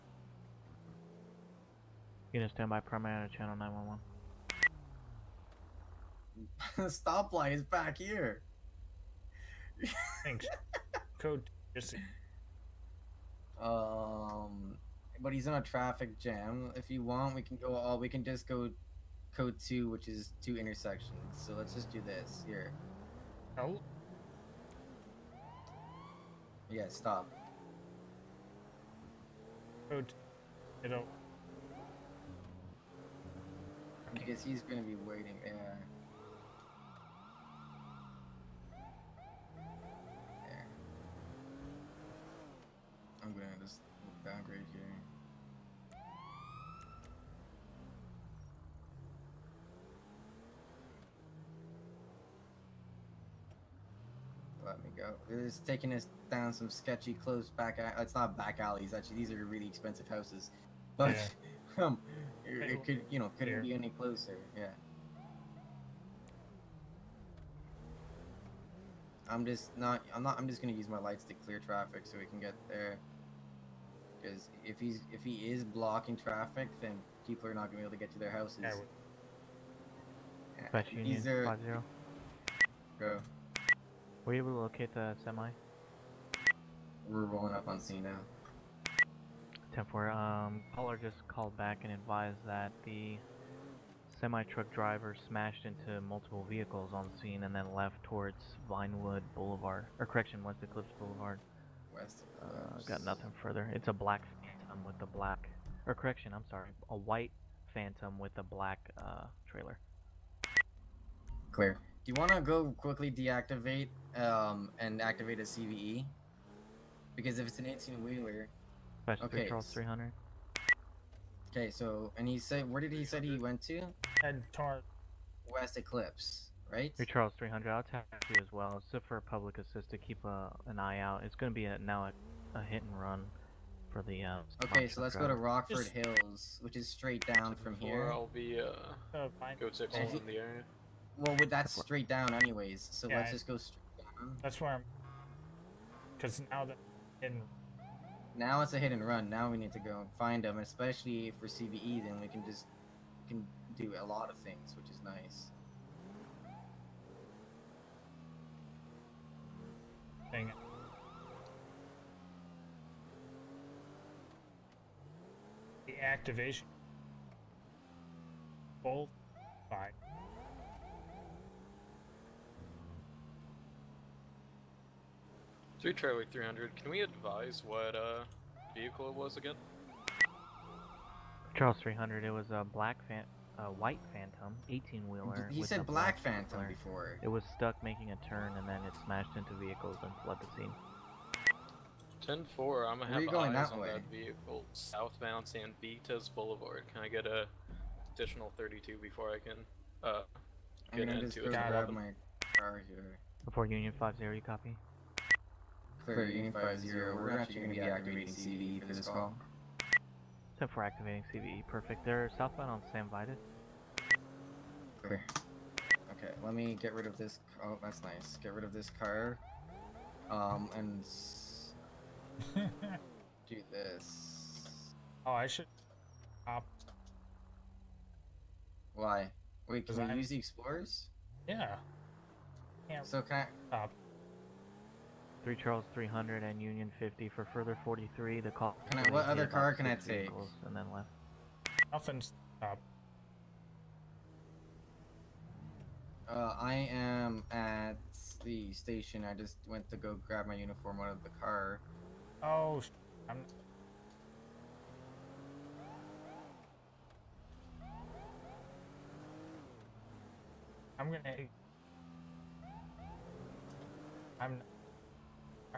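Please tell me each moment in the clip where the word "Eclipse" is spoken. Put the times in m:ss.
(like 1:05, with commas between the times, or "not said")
1:40, 2:05.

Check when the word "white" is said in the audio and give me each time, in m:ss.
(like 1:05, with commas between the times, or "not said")
1:46, 3:03.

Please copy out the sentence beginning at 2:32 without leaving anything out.
Then we can just can do a lot of things, which is nice.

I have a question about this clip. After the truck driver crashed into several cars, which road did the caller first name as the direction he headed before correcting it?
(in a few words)
Vinewood Boulevard.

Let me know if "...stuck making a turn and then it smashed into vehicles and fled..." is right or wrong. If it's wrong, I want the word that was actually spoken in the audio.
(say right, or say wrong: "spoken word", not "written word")
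right.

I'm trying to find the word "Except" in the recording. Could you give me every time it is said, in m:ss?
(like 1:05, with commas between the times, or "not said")
3:30.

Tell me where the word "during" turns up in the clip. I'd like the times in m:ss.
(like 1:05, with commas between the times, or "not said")
not said.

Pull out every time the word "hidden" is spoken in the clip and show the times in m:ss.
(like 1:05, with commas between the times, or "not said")
2:27.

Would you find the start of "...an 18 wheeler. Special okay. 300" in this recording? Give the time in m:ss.
1:57.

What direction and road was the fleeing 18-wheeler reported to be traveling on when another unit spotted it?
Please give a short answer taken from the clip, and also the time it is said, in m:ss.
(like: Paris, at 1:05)
Southbound San Vitus Boulevard, at 3:14.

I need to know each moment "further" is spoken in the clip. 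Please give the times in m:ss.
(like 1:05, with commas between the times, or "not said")
1:43, 3:57.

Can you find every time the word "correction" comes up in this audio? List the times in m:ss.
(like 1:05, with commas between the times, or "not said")
1:40, 1:45.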